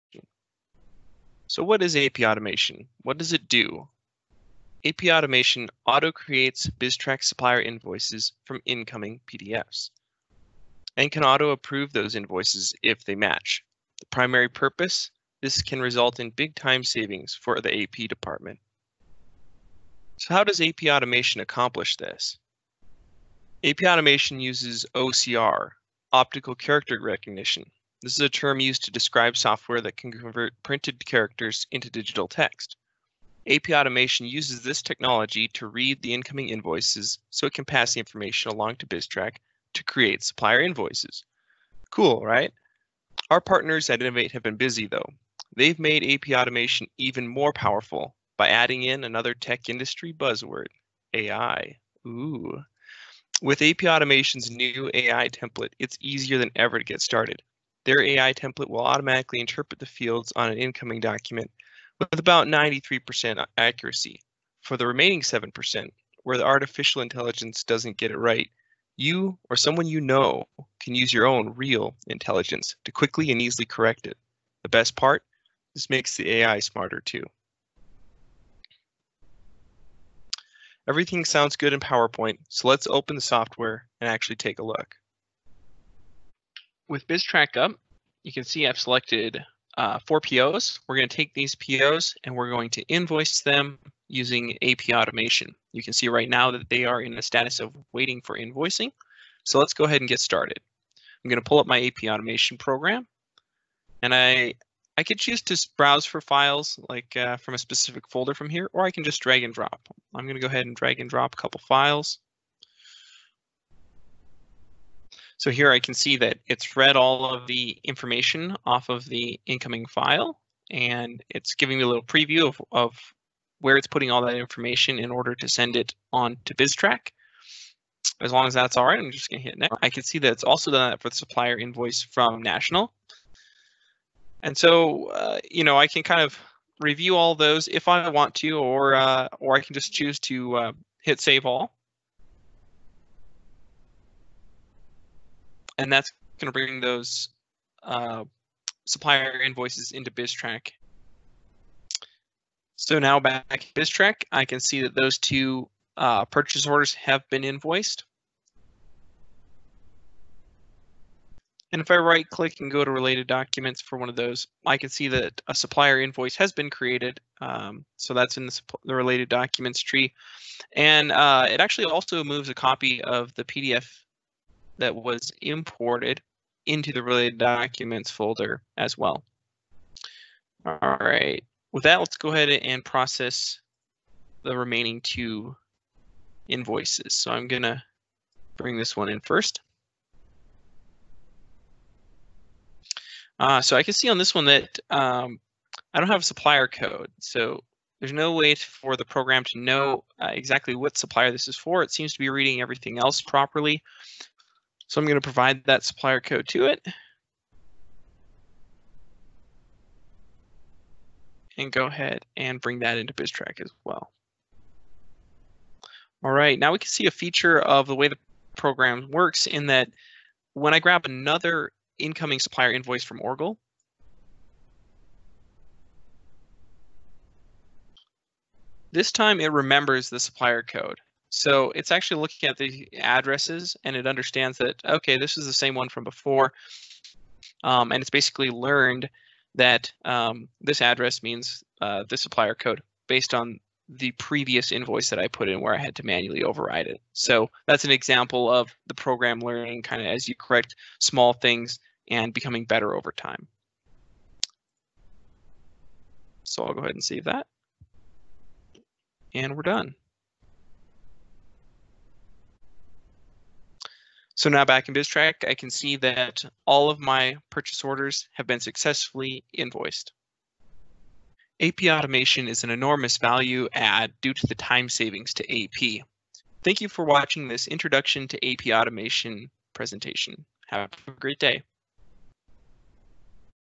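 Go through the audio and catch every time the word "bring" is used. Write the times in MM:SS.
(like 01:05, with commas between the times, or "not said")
02:26, 03:08, 03:32.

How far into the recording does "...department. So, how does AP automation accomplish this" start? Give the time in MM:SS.
00:18.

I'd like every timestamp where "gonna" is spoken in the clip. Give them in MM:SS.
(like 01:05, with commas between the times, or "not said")
02:09, 03:07.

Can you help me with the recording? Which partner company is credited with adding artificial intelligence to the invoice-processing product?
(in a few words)
Innovate.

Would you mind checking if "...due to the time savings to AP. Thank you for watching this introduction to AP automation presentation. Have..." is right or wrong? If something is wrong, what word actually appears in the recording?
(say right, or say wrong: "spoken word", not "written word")
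right.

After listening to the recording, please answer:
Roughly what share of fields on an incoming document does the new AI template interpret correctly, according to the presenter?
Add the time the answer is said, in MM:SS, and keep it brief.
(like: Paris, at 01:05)
93%, at 01:02.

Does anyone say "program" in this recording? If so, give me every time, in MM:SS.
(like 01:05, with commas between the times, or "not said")
01:42, 03:19, 03:38, 04:08.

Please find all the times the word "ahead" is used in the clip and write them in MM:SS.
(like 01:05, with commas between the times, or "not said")
01:39, 01:50, 03:02, 03:31, 04:16.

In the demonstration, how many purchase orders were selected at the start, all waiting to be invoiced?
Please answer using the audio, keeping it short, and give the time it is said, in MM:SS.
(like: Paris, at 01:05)
4, at 01:30.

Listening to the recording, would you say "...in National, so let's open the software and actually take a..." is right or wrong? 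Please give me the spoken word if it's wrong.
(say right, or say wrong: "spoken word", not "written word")
wrong: "PowerPoint", not "National".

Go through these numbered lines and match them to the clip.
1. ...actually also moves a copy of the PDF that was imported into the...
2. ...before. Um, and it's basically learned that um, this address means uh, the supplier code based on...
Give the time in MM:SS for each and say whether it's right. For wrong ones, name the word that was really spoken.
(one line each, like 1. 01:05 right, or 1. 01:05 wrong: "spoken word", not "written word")
1. 02:51 right
2. 03:56 right.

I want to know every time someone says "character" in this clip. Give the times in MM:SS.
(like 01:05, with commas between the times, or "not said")
00:26, 00:31.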